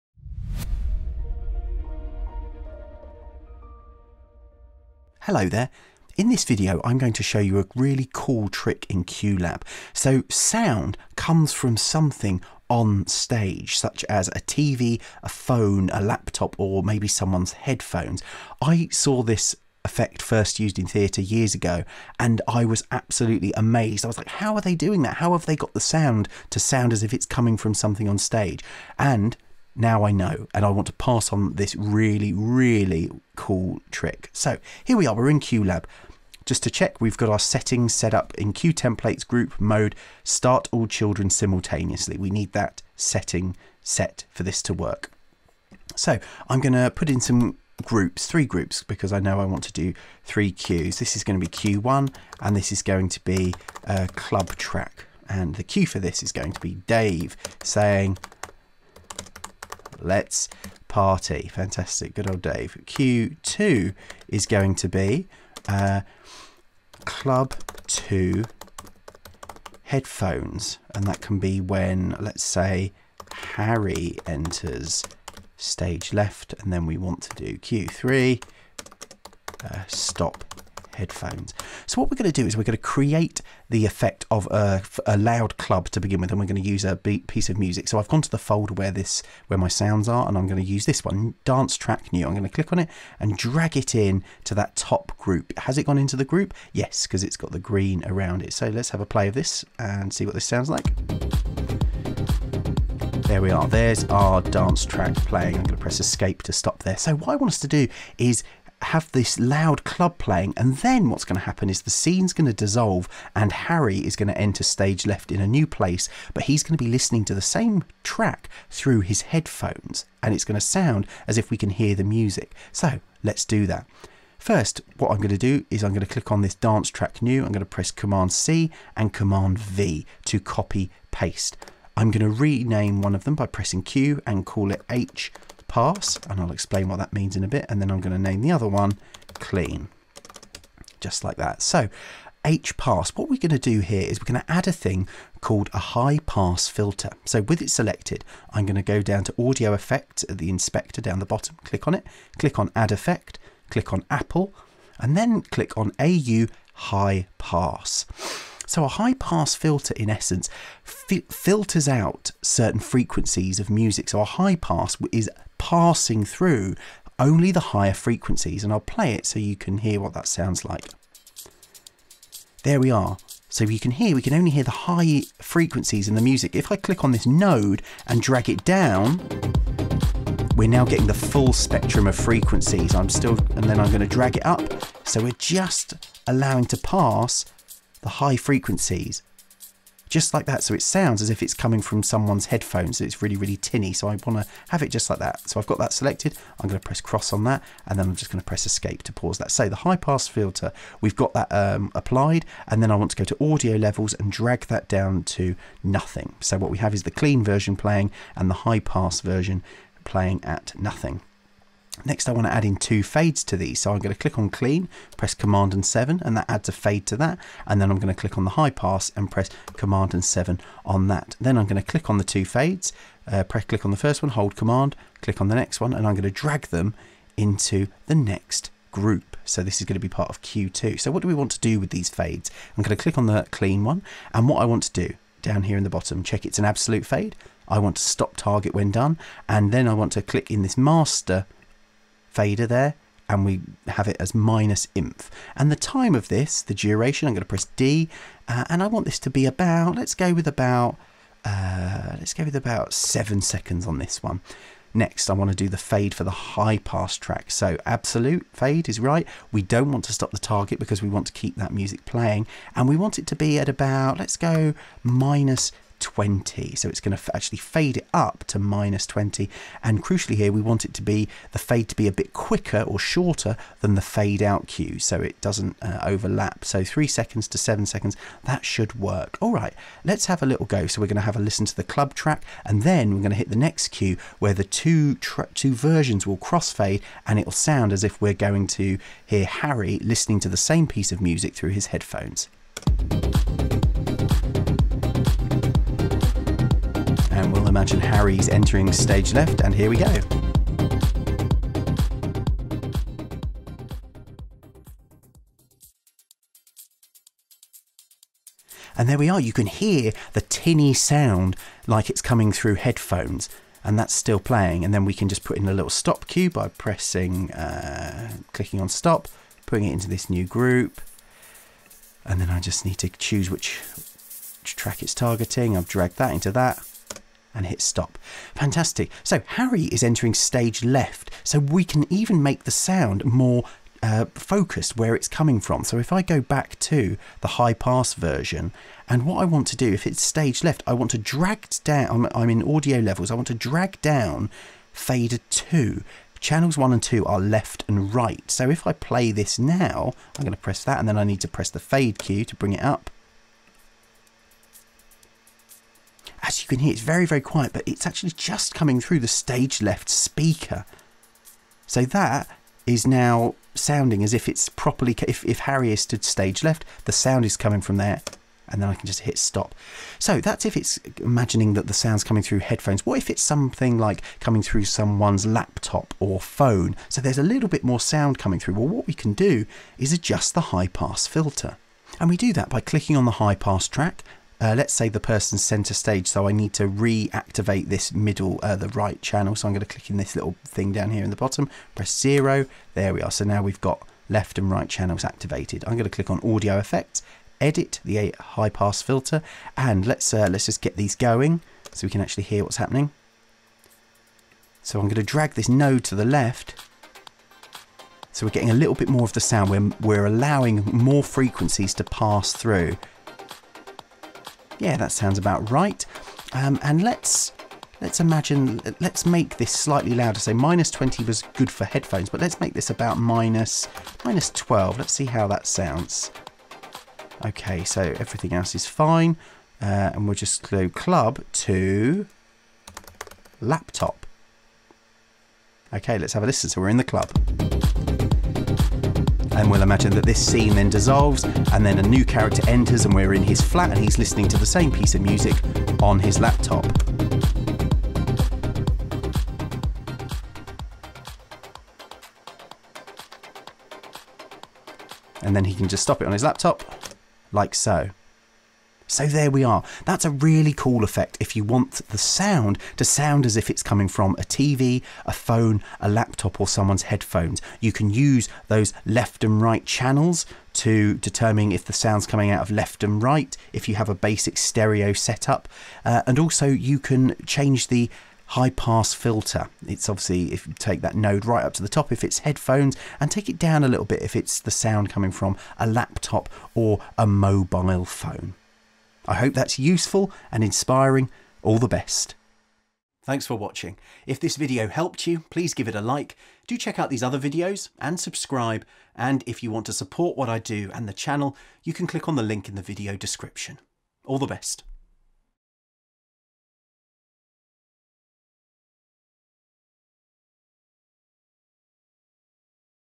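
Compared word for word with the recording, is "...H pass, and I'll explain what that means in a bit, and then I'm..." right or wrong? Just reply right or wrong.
right.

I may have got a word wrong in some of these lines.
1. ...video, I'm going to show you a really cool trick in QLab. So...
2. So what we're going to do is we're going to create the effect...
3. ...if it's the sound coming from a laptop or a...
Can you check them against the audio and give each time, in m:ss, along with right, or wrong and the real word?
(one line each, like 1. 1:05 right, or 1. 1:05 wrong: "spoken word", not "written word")
1. 0:06 right
2. 1:21 right
3. 8:04 right.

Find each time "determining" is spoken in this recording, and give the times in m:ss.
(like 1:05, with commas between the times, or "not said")
7:51.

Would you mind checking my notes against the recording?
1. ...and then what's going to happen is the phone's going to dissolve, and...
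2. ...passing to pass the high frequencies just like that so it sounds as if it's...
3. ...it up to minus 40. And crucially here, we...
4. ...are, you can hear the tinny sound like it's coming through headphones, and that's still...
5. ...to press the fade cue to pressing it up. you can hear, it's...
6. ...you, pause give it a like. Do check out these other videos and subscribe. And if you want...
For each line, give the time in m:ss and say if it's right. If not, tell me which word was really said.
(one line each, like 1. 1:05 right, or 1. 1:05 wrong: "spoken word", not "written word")
1. 1:50 wrong: "scene", not "phone"
2. 3:06 wrong: "allowing", not "passing"
3. 4:27 wrong: "20", not "40"
4. 5:09 right
5. 5:51 wrong: "bring", not "pressing"
6. 8:15 wrong: "please", not "pause".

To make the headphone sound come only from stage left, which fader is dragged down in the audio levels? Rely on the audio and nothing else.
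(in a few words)
Fader 2.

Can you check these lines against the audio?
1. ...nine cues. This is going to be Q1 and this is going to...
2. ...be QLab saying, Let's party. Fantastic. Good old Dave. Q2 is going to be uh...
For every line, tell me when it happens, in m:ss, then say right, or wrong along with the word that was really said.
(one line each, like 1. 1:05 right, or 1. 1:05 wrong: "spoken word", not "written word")
1. 0:50 wrong: "three", not "nine"
2. 0:56 wrong: "Dave", not "QLab".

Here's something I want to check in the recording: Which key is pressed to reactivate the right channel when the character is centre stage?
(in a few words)
0.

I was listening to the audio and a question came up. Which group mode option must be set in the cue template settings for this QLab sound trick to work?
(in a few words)
Start all children simultaneously.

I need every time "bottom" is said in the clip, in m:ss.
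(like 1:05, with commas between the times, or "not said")
2:31, 3:55, 6:31.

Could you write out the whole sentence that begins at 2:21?
So H pass, what we're going to do here is we're going to add a thing called a high pass filter.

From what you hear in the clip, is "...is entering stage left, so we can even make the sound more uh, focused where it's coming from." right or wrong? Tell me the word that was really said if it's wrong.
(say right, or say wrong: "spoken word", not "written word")
right.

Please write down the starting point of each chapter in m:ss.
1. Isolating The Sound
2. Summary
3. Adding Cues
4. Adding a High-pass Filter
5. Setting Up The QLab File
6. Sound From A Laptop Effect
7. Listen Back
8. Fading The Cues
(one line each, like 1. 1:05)
1. 5:29
2. 7:38
3. 0:46
4. 2:22
5. 0:34
6. 6:10
7. 4:39
8. 3:31.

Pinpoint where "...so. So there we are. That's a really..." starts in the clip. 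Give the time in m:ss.
7:37.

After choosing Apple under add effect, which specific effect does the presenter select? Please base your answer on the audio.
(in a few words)
AU high pass.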